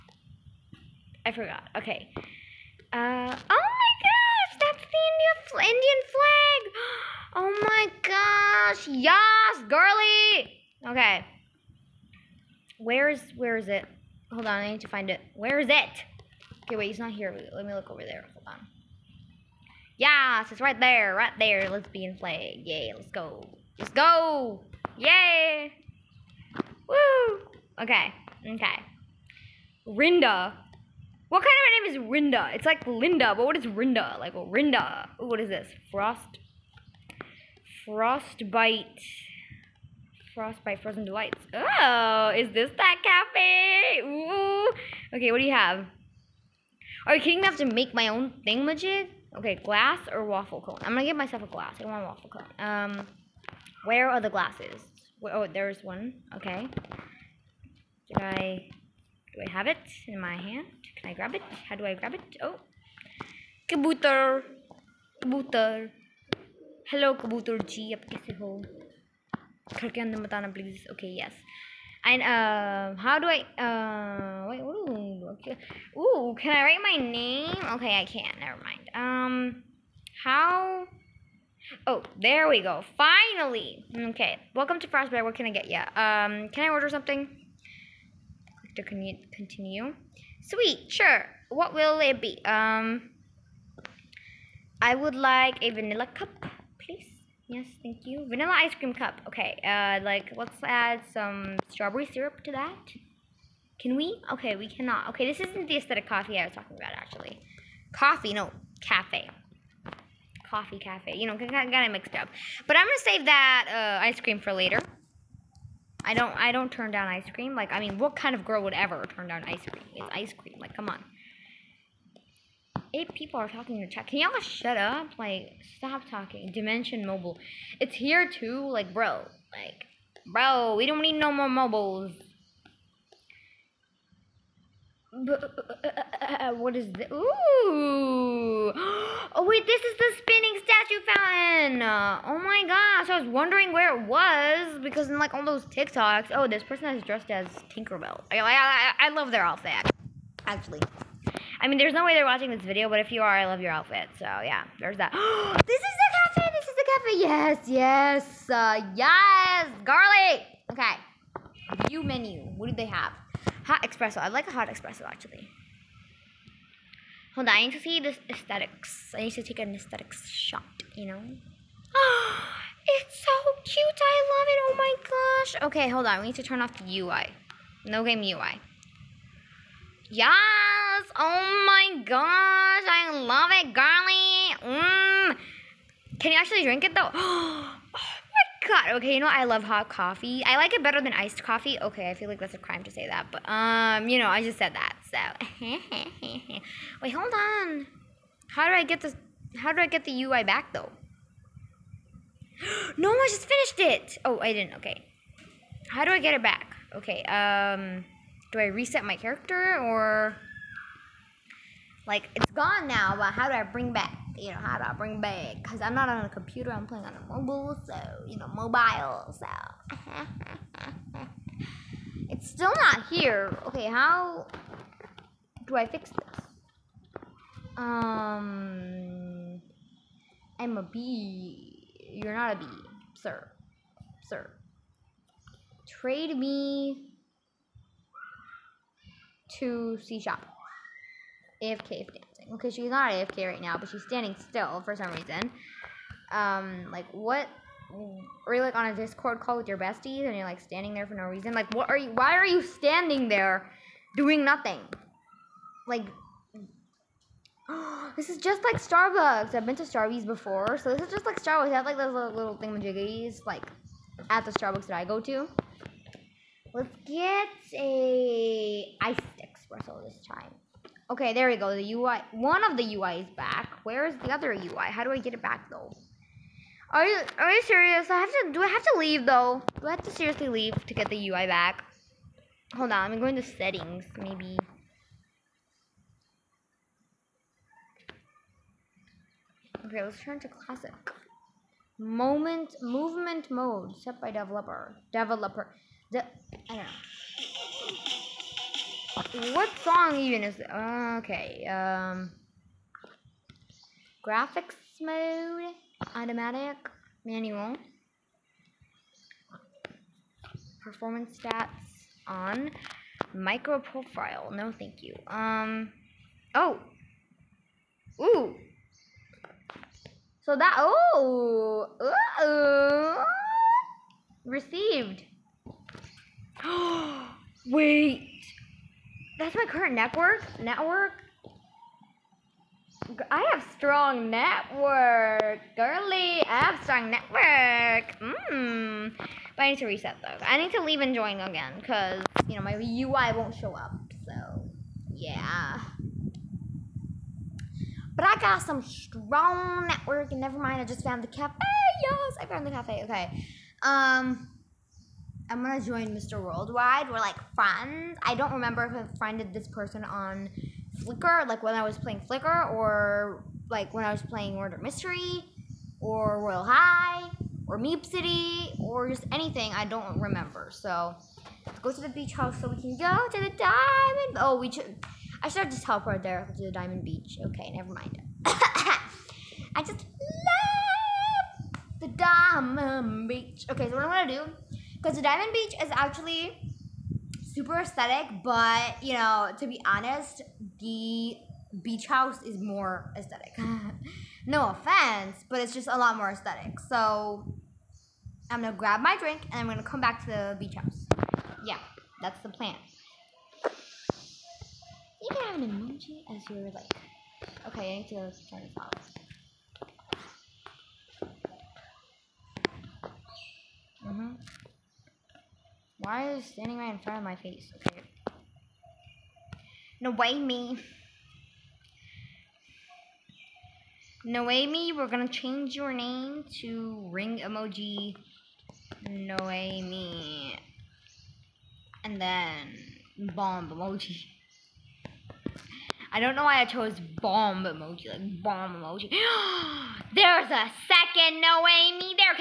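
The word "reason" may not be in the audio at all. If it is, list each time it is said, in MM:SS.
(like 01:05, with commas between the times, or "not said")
04:05, 04:11.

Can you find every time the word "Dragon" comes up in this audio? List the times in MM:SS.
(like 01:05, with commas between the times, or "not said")
not said.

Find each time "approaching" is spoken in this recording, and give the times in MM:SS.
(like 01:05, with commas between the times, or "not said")
not said.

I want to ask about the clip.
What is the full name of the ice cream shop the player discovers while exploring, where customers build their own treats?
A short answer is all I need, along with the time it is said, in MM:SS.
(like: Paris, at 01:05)
Frostbite Frozen Delights, at 00:40.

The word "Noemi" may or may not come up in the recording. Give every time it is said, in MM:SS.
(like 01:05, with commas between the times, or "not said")
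06:59, 07:04, 07:09, 07:21.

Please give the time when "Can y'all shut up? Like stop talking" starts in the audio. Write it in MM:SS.
02:04.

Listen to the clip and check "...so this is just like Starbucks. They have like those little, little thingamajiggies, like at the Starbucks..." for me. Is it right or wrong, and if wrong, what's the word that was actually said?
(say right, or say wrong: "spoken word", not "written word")
right.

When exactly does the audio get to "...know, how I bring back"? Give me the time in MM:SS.
03:34.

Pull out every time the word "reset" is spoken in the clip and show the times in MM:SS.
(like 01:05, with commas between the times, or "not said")
03:28, 05:39.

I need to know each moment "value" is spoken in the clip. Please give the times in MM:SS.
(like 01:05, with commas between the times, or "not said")
not said.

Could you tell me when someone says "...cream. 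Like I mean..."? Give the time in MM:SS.
01:57.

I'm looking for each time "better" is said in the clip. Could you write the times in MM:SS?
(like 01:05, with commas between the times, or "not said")
03:10.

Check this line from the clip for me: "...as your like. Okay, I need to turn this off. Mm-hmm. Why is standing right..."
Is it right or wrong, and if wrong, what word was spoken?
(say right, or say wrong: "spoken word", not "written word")
right.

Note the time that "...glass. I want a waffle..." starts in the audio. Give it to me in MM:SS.
00:51.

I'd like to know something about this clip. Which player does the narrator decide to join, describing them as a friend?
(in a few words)
Mr. Worldwide.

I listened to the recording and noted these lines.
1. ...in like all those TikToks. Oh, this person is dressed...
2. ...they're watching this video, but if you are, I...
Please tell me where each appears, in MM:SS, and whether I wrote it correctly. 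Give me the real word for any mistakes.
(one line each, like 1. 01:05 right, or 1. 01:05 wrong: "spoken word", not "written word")
1. 02:25 right
2. 02:32 right.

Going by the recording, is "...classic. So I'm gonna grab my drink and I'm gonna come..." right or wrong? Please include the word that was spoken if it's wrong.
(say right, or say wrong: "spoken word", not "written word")
wrong: "aesthetic", not "classic".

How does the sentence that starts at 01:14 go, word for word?
Ooh, Ooh, can I write my name?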